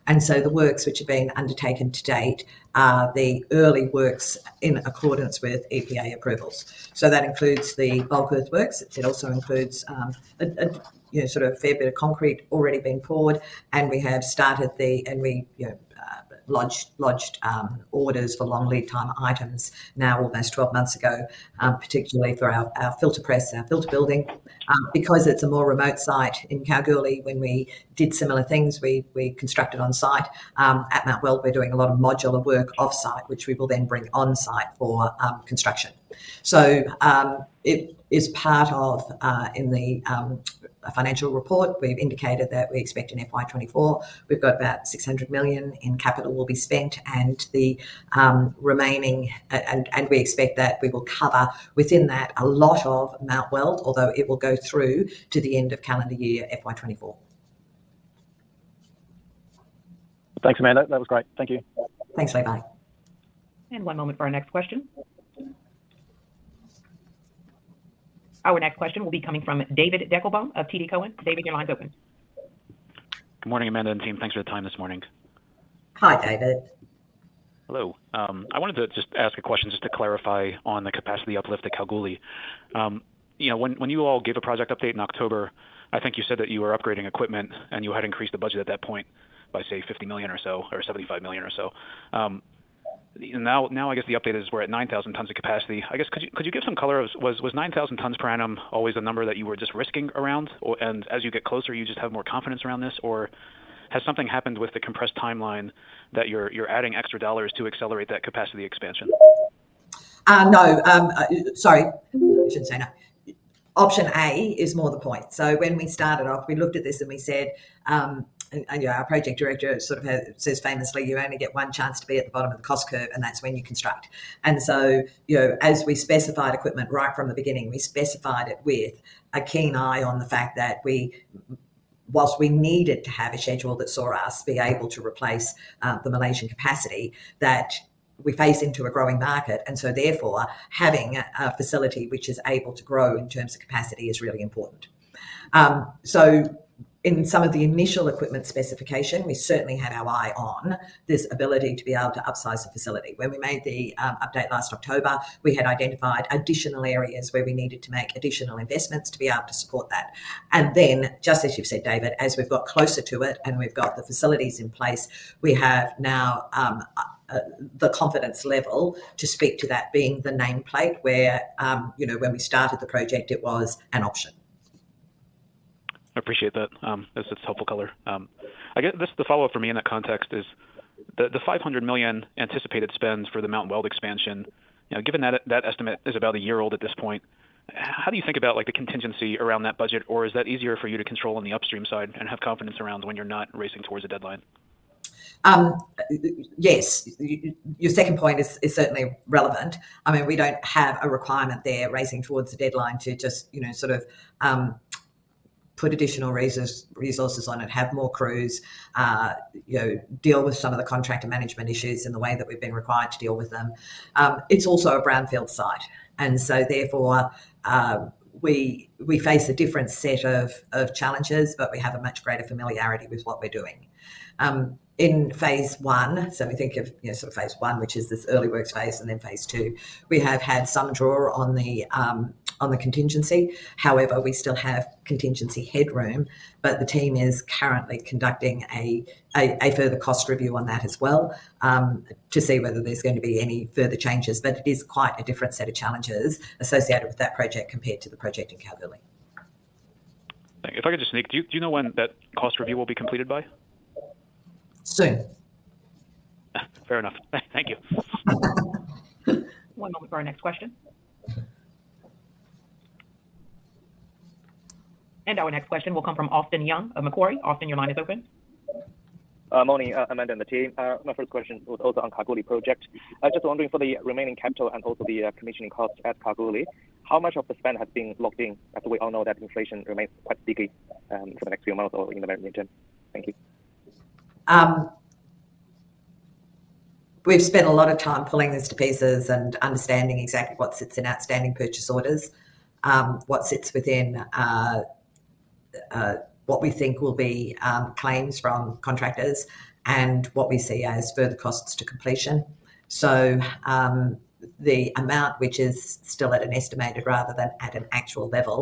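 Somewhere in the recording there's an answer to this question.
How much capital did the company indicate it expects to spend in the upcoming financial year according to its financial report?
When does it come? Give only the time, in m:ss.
0:44.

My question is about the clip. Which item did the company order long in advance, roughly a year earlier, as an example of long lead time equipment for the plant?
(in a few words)
filter press.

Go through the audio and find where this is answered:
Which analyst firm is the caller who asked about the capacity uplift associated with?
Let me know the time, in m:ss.
1:10.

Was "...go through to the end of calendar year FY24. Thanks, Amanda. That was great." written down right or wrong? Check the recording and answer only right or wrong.
right.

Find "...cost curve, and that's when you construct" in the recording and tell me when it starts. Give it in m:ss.
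2:02.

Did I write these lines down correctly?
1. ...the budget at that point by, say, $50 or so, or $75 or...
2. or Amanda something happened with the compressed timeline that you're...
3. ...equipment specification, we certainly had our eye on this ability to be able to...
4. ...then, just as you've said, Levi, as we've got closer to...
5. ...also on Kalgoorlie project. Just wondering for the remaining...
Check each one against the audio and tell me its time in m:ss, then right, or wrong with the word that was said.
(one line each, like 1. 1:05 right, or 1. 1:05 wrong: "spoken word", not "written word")
1. 1:28 right
2. 1:43 wrong: "Has", not "Amanda"
3. 2:28 right
4. 2:40 wrong: "David", not "Levi"
5. 4:31 right.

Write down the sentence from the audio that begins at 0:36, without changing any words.
So um, it is part of uh, in the um, financial report.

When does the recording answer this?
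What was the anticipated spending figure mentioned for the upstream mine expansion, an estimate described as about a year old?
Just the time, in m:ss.
3:01.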